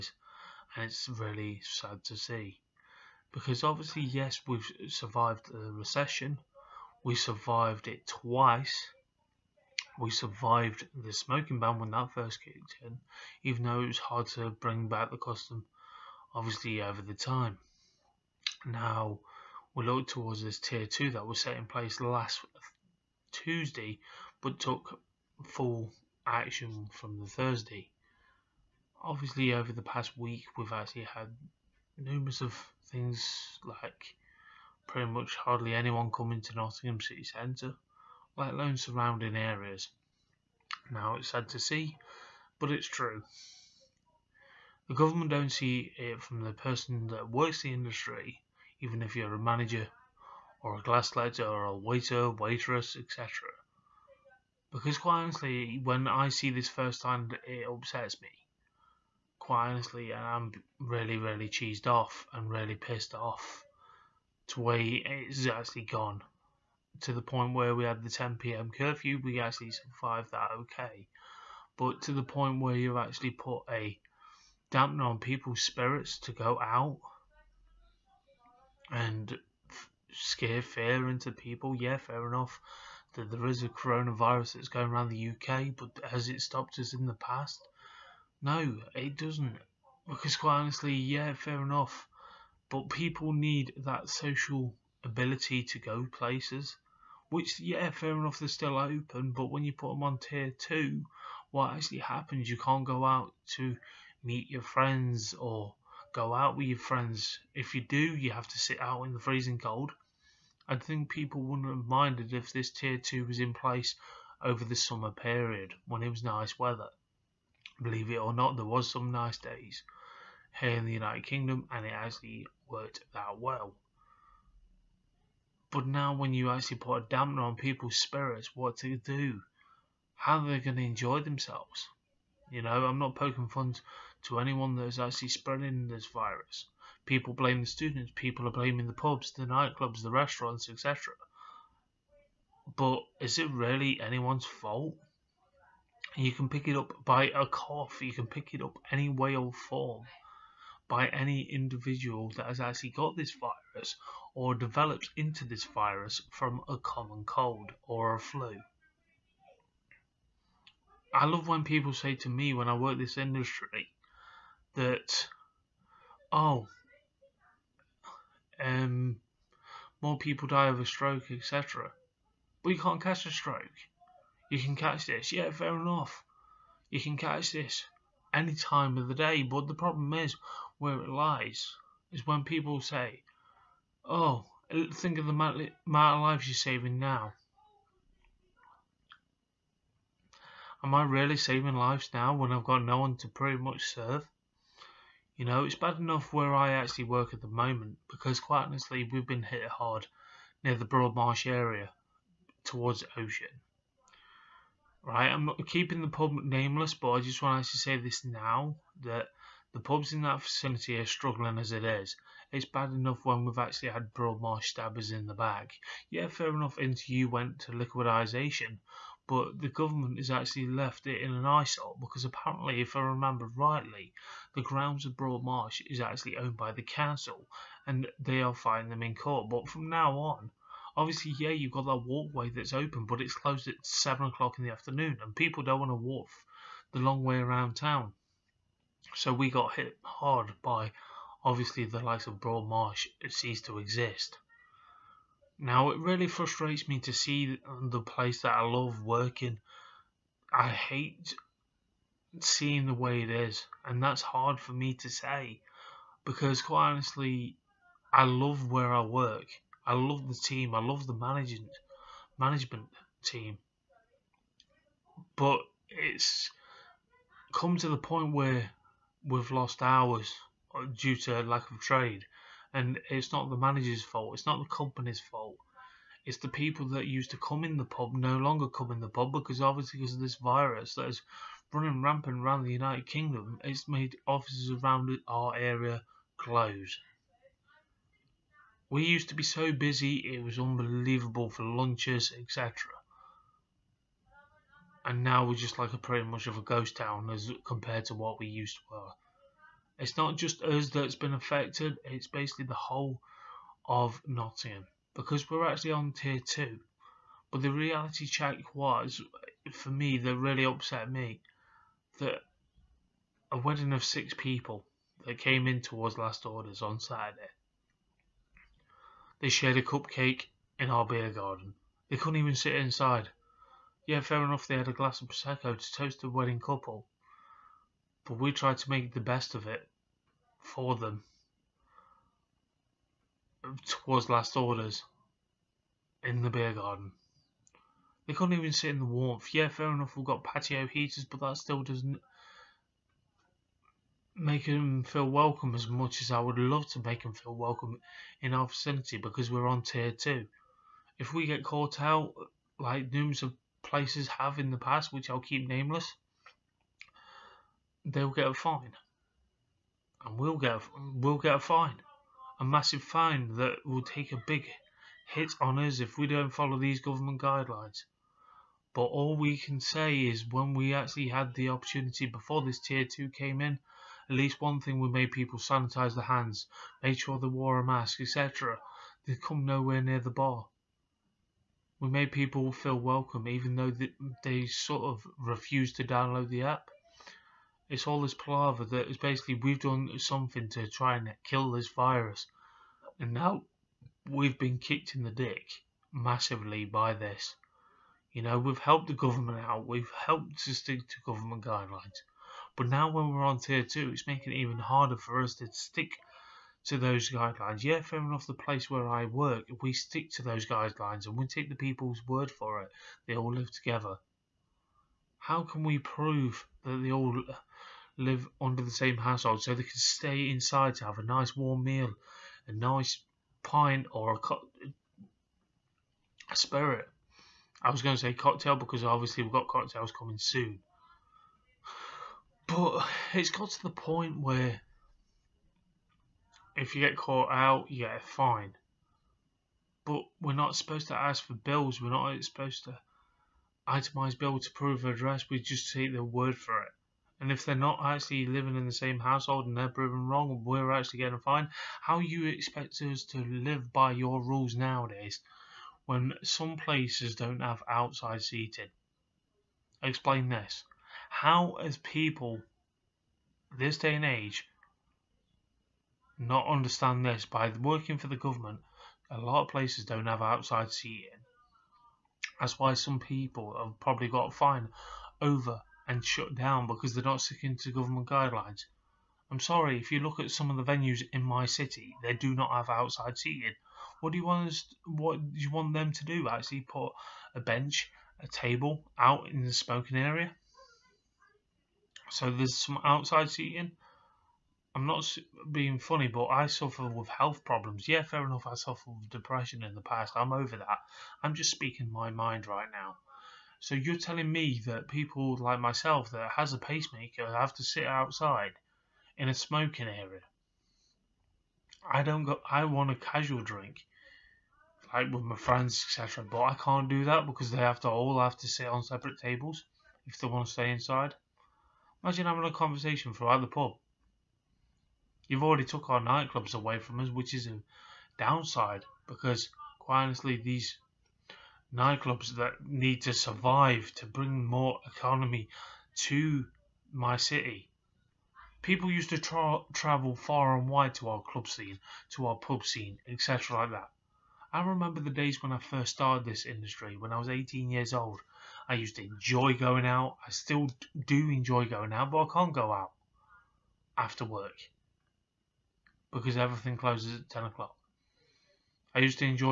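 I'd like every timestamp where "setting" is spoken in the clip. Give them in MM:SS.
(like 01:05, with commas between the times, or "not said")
not said.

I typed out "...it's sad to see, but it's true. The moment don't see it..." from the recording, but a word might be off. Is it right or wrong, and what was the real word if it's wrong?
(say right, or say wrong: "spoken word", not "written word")
wrong: "government", not "moment".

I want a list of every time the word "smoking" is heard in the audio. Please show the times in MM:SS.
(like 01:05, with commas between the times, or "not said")
00:11, 08:09, 08:29.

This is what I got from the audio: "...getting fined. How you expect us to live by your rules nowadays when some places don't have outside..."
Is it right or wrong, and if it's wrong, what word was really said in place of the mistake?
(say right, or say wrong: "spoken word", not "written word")
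right.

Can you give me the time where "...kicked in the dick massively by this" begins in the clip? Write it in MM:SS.
06:34.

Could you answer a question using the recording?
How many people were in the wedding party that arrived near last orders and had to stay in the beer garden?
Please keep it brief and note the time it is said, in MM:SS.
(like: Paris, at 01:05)
6, at 05:14.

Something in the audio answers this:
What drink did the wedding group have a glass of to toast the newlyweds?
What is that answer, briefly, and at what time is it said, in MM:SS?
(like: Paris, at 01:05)
Prosecco, at 05:25.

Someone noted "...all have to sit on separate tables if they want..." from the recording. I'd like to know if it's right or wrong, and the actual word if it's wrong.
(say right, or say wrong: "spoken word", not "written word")
right.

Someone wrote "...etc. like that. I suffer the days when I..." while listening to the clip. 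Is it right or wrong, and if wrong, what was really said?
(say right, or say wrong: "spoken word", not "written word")
wrong: "remember", not "suffer".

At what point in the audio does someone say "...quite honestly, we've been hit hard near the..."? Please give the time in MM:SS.
03:18.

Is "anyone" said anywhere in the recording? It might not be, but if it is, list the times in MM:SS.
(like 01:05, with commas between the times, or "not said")
00:35, 02:14, 02:24.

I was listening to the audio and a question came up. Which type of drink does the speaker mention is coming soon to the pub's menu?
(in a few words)
Cocktails.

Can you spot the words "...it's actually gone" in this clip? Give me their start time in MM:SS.
01:04.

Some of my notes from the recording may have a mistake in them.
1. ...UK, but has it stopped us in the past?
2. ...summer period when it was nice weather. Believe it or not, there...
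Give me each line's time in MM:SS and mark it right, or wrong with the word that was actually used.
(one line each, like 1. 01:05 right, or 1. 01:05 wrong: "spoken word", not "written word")
1. 01:25 right
2. 01:54 right.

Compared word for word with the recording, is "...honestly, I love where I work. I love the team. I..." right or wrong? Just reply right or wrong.
right.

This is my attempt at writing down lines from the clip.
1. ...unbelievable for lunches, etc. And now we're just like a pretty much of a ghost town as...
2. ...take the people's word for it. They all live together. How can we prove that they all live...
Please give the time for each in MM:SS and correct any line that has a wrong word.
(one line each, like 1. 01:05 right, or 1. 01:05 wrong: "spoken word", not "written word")
1. 04:50 right
2. 06:51 right.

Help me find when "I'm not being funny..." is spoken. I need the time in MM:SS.
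08:14.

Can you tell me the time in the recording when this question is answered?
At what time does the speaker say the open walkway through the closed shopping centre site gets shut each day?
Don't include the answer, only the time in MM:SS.
03:53.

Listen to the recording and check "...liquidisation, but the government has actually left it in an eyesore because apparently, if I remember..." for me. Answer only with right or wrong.
right.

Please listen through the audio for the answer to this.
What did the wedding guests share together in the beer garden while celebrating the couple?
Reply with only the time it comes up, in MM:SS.
05:19.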